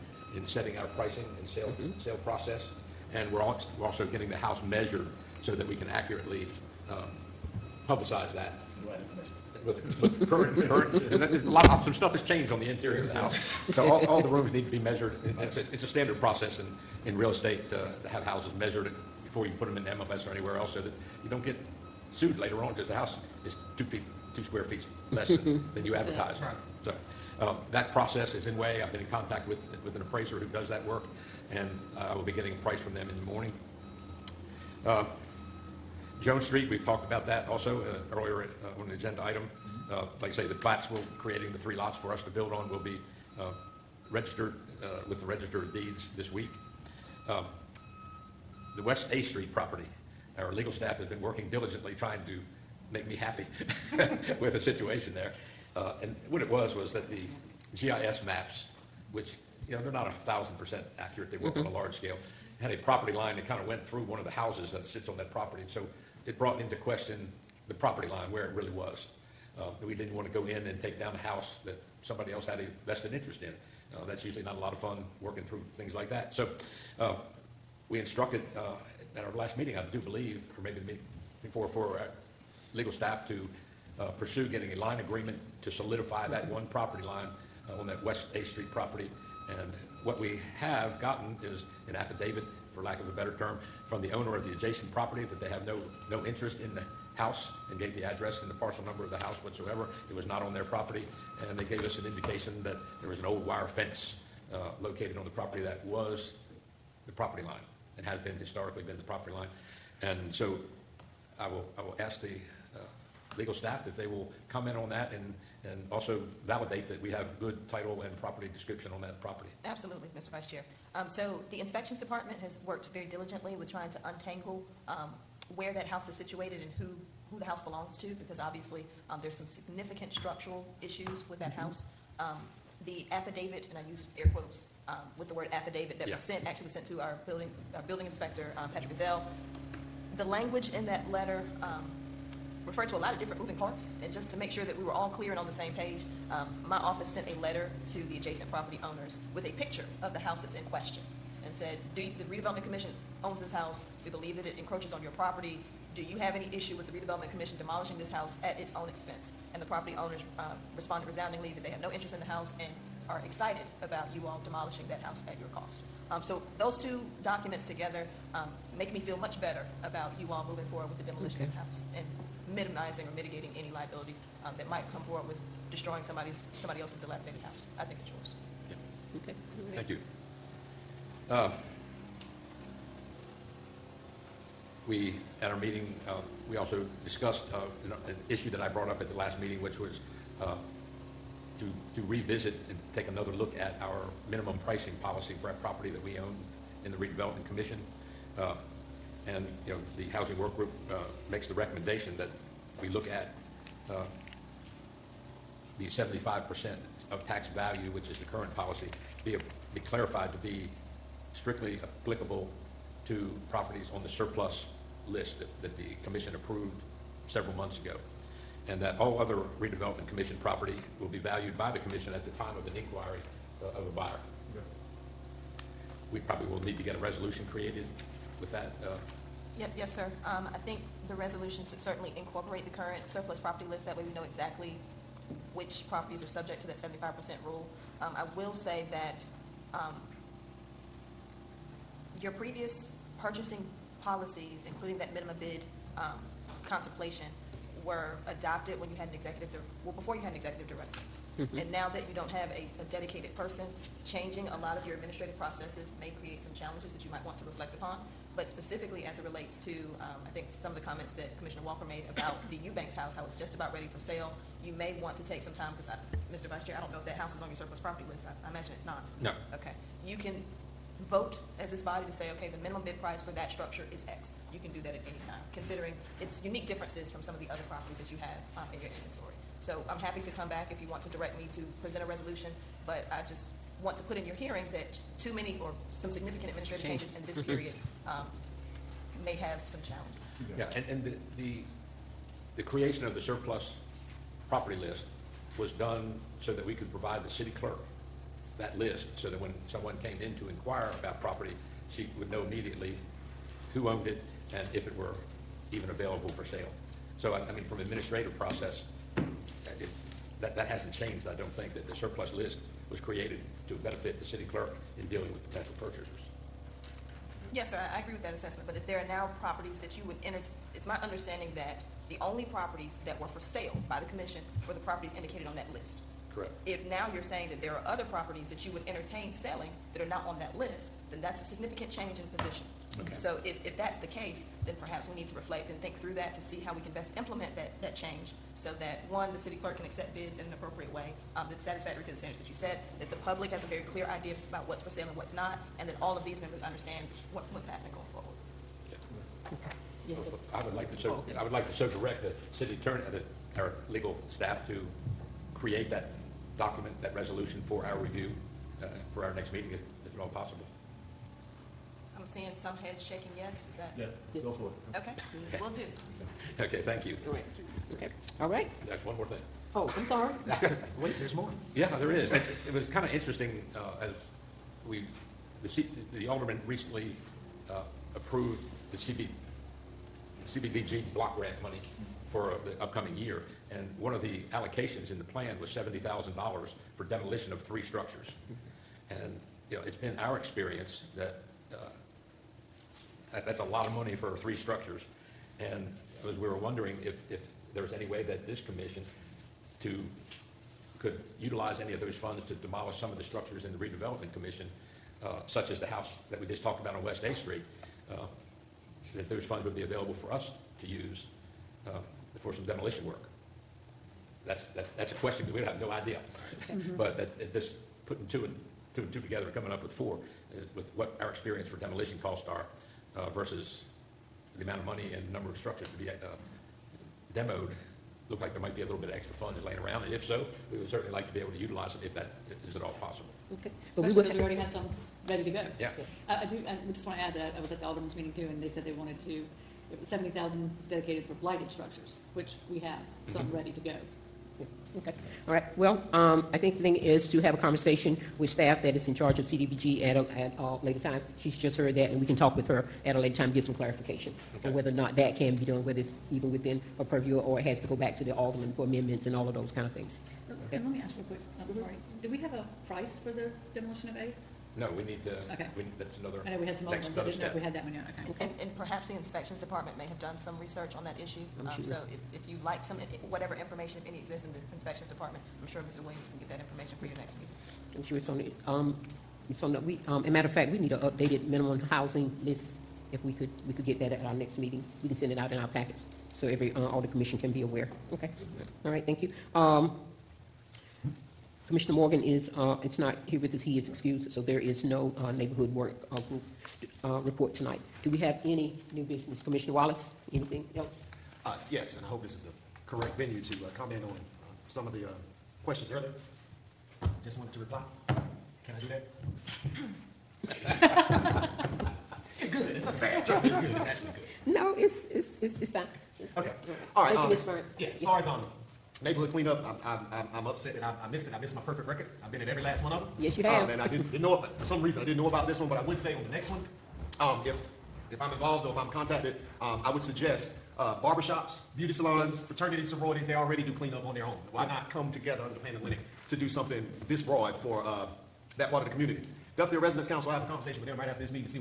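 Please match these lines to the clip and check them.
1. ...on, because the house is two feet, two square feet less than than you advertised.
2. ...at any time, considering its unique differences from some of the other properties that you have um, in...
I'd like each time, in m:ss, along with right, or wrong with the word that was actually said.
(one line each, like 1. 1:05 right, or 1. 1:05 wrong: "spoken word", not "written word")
1. 0:22 right
2. 4:34 right.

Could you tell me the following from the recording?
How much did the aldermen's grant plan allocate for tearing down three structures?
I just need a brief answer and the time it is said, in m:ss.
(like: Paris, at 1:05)
$70,000, at 6:25.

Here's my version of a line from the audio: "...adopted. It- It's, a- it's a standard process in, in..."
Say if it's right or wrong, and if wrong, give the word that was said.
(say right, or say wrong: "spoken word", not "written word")
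wrong: "measured", not "adopted".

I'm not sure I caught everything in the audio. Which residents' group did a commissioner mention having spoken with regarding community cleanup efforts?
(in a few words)
Duffyfield Residents Council.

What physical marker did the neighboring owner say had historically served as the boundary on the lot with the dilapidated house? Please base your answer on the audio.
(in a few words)
old wire fence.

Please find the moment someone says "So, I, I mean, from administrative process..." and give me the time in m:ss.
5:07.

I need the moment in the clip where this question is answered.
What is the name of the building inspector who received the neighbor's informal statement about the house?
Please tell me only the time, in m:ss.
2:18.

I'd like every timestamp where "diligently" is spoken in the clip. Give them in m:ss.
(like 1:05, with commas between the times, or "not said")
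0:51, 2:03.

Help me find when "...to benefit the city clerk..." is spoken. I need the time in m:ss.
5:13.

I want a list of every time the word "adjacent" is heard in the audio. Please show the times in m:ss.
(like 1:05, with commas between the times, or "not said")
1:34, 2:28.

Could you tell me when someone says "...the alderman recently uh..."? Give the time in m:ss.
6:16.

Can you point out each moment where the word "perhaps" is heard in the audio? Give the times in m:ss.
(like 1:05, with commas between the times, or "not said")
5:34, 7:48.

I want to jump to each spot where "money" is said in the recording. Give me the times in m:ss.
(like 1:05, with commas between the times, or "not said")
6:21, 6:33, 7:04.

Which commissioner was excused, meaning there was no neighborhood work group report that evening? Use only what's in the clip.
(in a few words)
Commissioner Morgan.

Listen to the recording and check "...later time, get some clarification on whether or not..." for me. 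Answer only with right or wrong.
right.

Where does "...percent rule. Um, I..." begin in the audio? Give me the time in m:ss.
3:57.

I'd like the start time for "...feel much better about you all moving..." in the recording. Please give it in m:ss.
2:48.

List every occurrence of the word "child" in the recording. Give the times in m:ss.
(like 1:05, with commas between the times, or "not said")
not said.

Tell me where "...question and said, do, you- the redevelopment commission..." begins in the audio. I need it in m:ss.
2:30.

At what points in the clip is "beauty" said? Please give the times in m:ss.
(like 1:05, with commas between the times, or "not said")
8:51.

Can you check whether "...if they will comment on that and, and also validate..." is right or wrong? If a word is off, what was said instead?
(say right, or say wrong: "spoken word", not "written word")
right.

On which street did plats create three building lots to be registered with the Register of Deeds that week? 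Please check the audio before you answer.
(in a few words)
Jones Street.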